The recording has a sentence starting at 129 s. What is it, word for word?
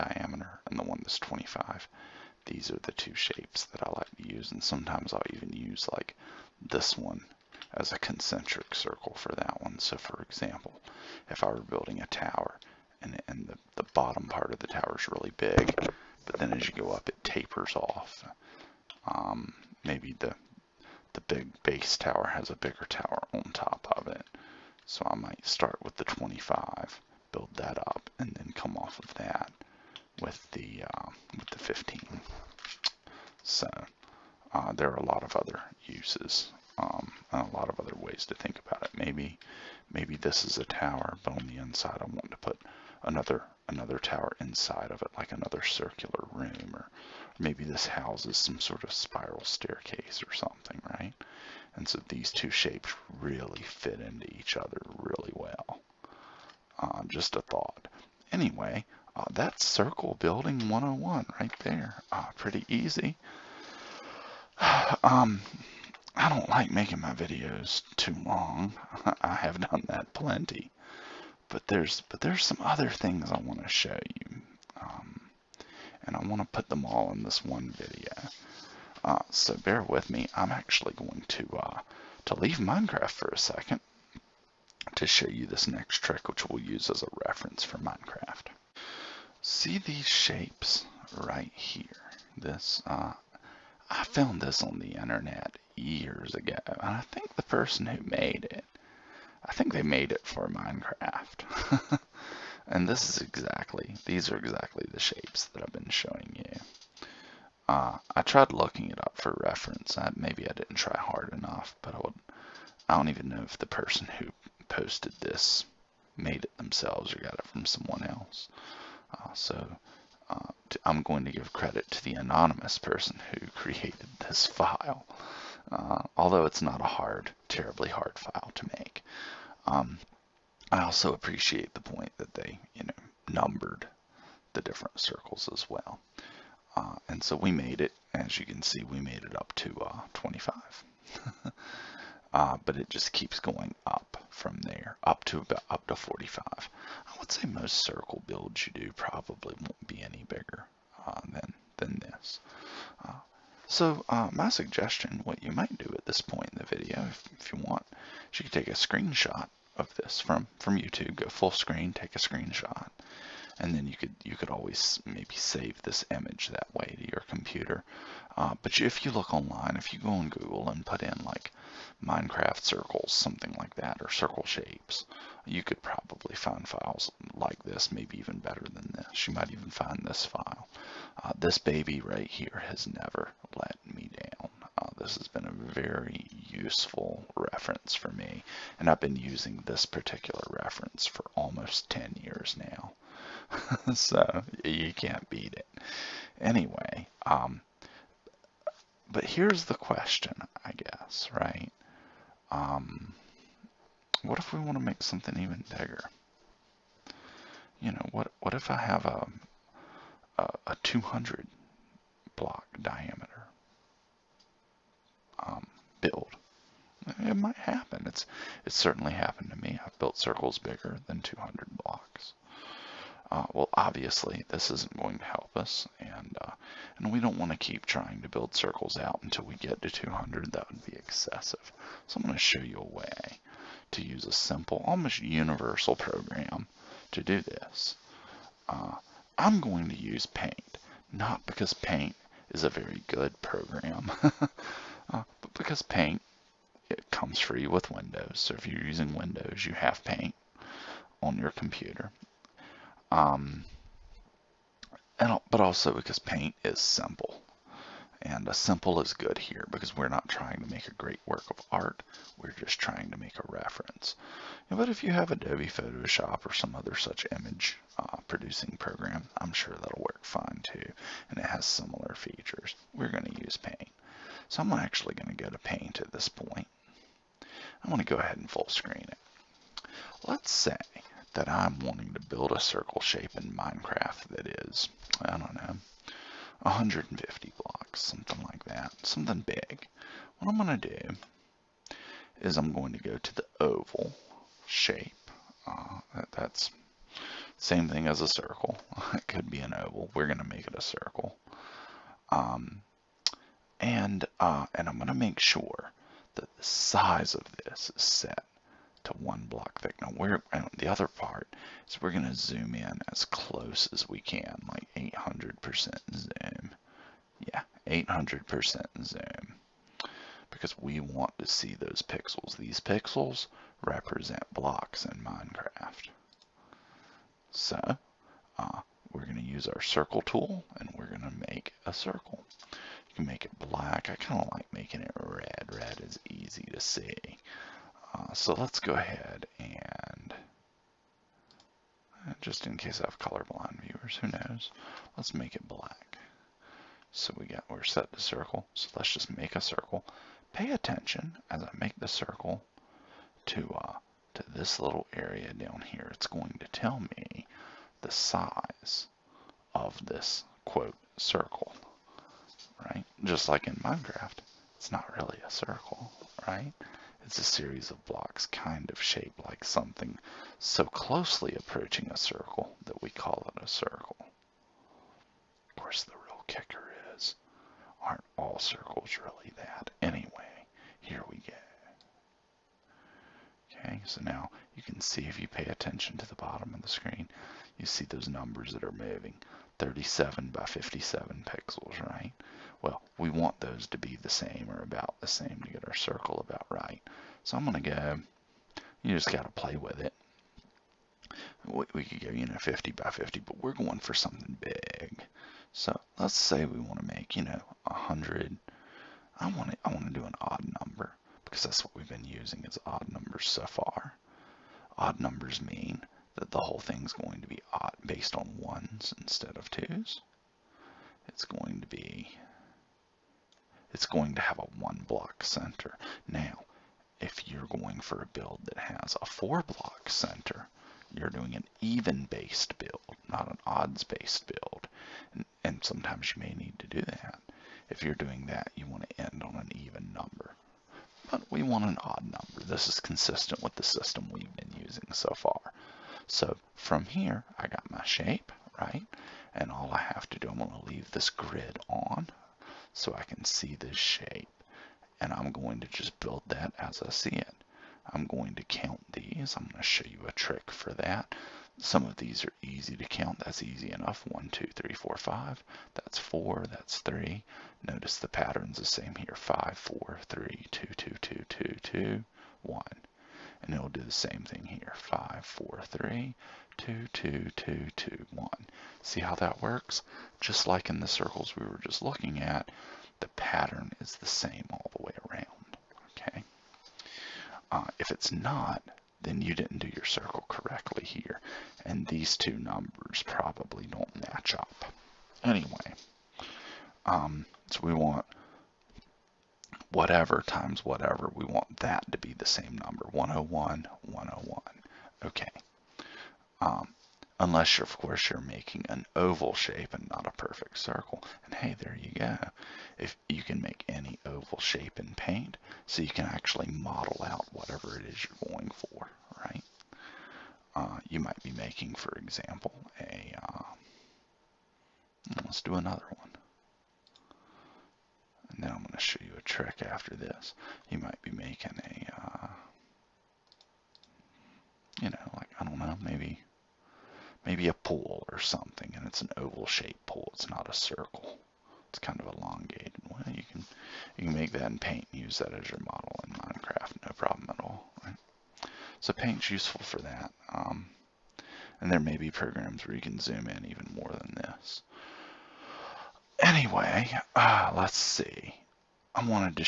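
Um, I also appreciate the point that they, you know, numbered the different circles as well.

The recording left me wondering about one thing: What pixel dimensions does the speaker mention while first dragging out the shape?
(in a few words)
37 by 57.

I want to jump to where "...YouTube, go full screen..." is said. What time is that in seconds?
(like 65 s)
160 s.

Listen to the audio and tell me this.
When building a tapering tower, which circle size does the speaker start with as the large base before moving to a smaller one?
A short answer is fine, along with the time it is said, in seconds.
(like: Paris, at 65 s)
25, at 24 s.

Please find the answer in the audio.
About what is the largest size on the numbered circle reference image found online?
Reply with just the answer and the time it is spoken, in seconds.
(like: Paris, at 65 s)
45, at 145 s.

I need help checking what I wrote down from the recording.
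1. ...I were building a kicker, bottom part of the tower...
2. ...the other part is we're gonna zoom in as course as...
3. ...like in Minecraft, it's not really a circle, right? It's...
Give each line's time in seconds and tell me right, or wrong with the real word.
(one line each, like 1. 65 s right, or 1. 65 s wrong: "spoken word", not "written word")
1. 11 s wrong: "tower", not "kicker"
2. 310 s wrong: "close", not "course"
3. 363 s right.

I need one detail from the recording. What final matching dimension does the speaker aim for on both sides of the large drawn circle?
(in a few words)
101.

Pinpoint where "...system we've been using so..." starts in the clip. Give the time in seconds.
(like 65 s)
443 s.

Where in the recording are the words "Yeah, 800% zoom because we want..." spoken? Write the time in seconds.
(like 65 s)
317 s.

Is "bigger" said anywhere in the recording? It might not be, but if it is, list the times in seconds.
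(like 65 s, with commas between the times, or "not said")
22 s, 150 s, 205 s, 220 s.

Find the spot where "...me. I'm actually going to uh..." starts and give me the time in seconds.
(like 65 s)
80 s.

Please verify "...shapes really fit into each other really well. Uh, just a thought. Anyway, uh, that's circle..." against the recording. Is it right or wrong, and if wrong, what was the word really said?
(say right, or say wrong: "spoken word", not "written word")
right.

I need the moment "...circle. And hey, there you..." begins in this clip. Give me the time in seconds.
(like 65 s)
510 s.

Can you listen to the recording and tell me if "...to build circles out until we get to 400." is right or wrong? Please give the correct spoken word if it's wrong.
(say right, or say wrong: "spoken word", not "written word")
wrong: "200", not "400".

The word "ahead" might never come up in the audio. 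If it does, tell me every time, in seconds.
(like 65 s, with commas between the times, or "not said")
278 s, 338 s.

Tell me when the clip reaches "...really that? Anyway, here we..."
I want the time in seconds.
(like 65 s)
379 s.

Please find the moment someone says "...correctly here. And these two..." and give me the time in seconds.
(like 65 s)
490 s.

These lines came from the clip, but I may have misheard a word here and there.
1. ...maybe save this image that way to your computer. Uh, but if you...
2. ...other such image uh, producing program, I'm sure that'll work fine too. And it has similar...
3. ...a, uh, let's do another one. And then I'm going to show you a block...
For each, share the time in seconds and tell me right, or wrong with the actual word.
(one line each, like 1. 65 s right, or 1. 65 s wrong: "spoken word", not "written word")
1. 165 s right
2. 266 s right
3. 522 s wrong: "trick", not "block".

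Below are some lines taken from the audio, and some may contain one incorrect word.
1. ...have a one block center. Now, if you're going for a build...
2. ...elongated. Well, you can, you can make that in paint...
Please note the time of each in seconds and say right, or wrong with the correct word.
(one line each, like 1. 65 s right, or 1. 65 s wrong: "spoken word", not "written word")
1. 424 s right
2. 542 s right.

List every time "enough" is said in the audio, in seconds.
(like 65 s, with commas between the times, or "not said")
111 s, 463 s.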